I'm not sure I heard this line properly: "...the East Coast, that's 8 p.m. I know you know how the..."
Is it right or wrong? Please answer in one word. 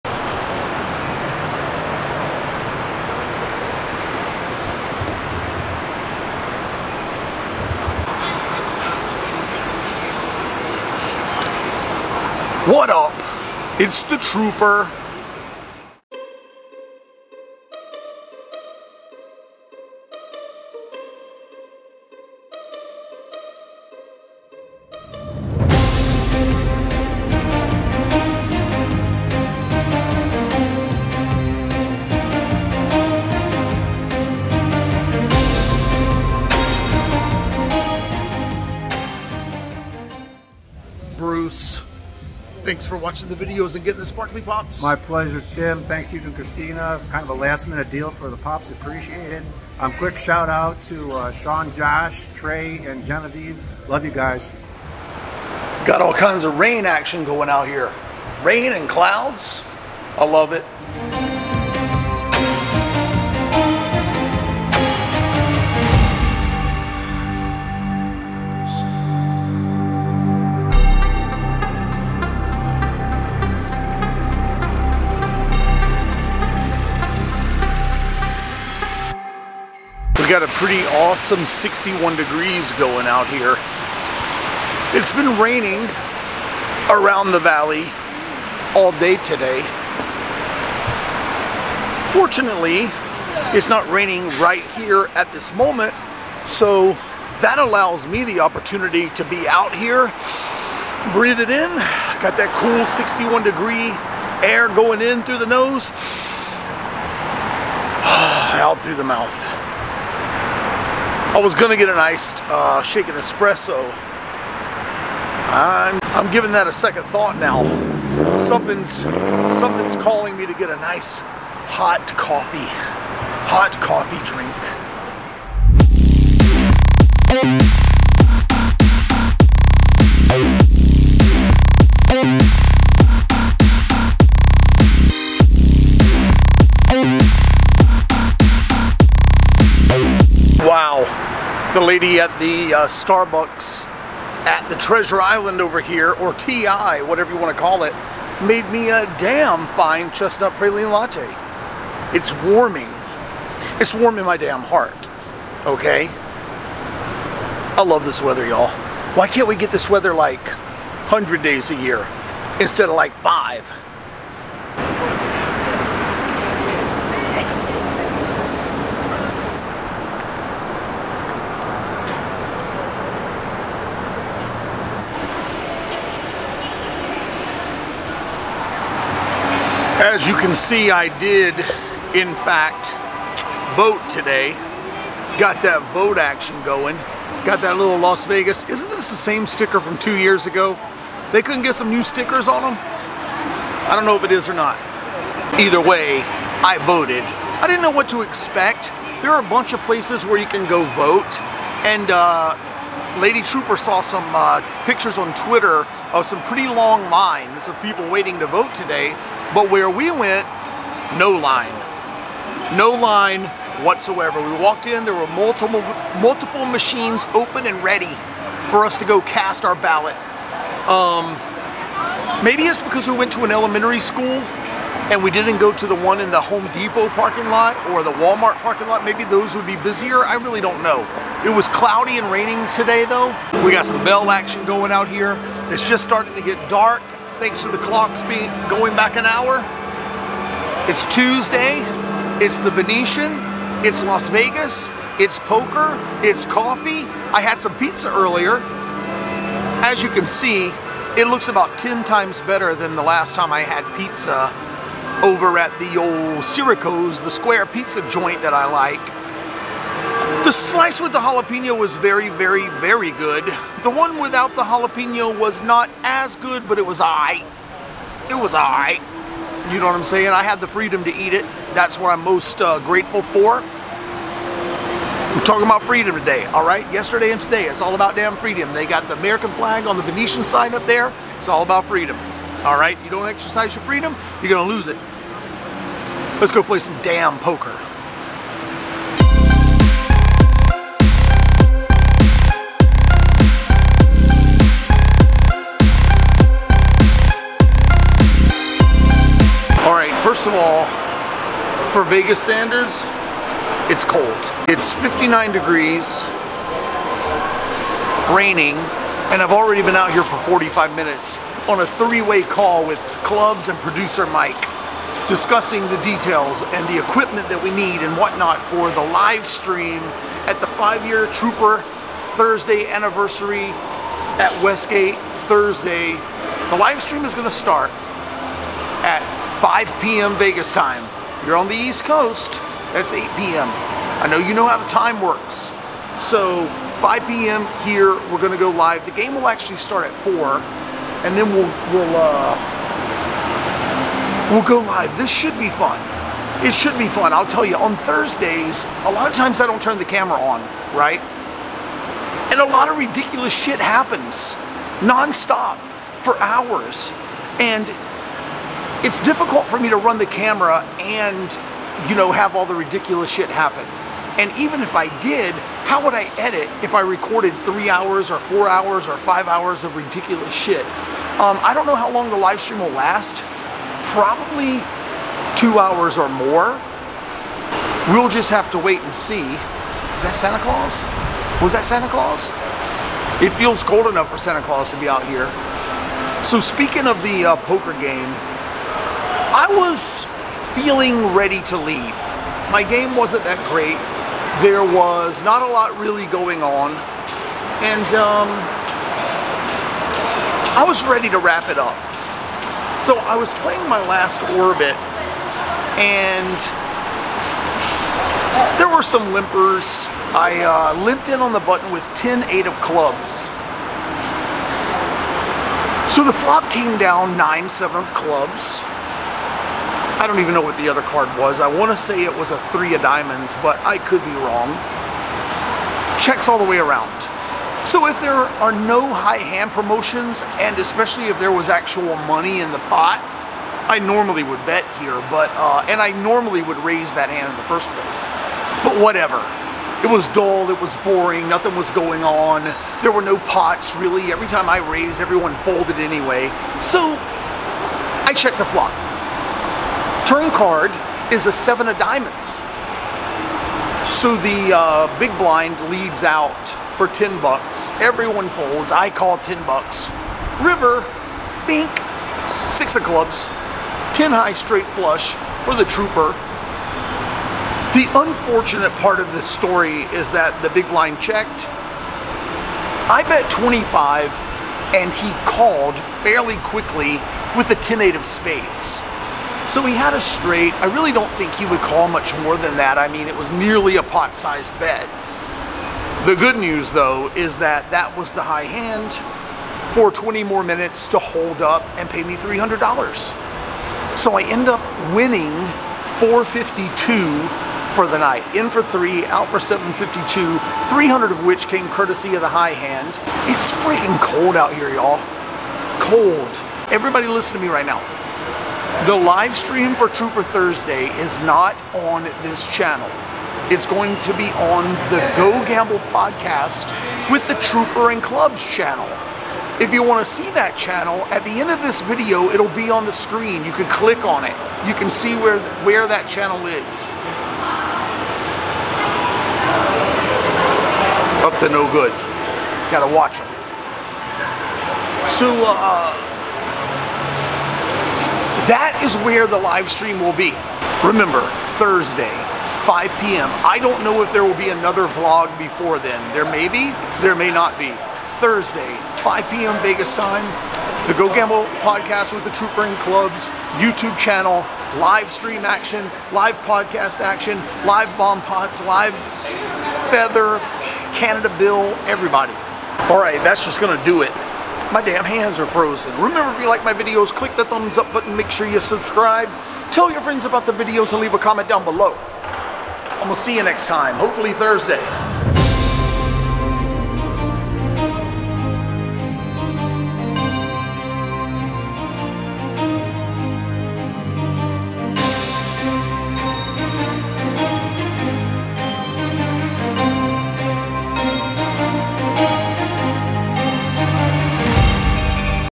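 right.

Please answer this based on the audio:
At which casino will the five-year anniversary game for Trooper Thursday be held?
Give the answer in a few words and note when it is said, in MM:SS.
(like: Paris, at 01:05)
Westgate, at 05:24.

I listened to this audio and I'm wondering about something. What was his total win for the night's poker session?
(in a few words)
$452.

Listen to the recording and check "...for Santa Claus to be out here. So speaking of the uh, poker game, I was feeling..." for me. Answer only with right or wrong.
right.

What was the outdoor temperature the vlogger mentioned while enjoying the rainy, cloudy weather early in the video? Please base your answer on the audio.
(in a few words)
61 degrees.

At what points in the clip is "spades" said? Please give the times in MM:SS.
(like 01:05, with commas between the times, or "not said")
07:58.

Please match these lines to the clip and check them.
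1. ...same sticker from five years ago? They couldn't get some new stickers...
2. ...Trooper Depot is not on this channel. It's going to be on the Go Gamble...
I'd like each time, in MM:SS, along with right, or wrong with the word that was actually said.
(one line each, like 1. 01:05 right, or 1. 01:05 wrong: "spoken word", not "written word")
1. 03:09 wrong: "two", not "five"
2. 08:30 wrong: "Thursday", not "Depot".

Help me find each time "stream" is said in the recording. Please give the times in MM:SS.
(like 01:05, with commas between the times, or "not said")
05:19, 05:27, 06:12, 08:29, 08:59, 09:15.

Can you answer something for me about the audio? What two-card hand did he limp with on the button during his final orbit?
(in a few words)
10 8 of clubs.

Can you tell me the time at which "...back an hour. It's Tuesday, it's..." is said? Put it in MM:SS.
03:58.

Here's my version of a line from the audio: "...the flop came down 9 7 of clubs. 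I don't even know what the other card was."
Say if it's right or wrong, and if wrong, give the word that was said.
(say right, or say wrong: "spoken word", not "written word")
right.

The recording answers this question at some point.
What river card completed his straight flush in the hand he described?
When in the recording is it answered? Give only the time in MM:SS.
07:42.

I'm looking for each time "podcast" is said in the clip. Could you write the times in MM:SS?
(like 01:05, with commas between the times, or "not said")
08:36, 09:11, 09:16.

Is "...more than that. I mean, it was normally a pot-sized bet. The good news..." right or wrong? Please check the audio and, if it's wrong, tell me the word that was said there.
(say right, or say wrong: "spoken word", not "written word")
wrong: "nearly", not "normally".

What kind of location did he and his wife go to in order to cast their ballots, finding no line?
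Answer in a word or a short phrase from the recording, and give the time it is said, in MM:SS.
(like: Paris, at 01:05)
an elementary school, at 03:43.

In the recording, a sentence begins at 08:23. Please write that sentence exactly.
It's freaking cold out here, y'all.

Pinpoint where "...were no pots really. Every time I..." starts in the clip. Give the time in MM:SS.
07:23.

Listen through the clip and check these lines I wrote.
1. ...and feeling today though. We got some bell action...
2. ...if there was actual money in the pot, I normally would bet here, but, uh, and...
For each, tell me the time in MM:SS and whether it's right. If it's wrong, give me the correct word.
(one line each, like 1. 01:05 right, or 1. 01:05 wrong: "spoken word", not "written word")
1. 03:52 wrong: "raining", not "feeling"
2. 07:11 right.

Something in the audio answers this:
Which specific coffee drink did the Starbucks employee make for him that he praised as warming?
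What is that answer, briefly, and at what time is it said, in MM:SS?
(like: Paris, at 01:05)
chestnut praline latte, at 02:30.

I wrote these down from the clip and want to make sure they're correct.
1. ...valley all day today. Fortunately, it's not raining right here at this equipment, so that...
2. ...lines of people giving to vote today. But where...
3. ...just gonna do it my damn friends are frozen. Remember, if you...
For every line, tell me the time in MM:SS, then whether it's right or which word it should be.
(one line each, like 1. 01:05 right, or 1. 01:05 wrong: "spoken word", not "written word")
1. 01:27 wrong: "moment", not "equipment"
2. 03:27 wrong: "waiting", not "giving"
3. 09:23 wrong: "hands", not "friends".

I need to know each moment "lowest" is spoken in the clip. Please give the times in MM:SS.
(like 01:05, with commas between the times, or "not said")
not said.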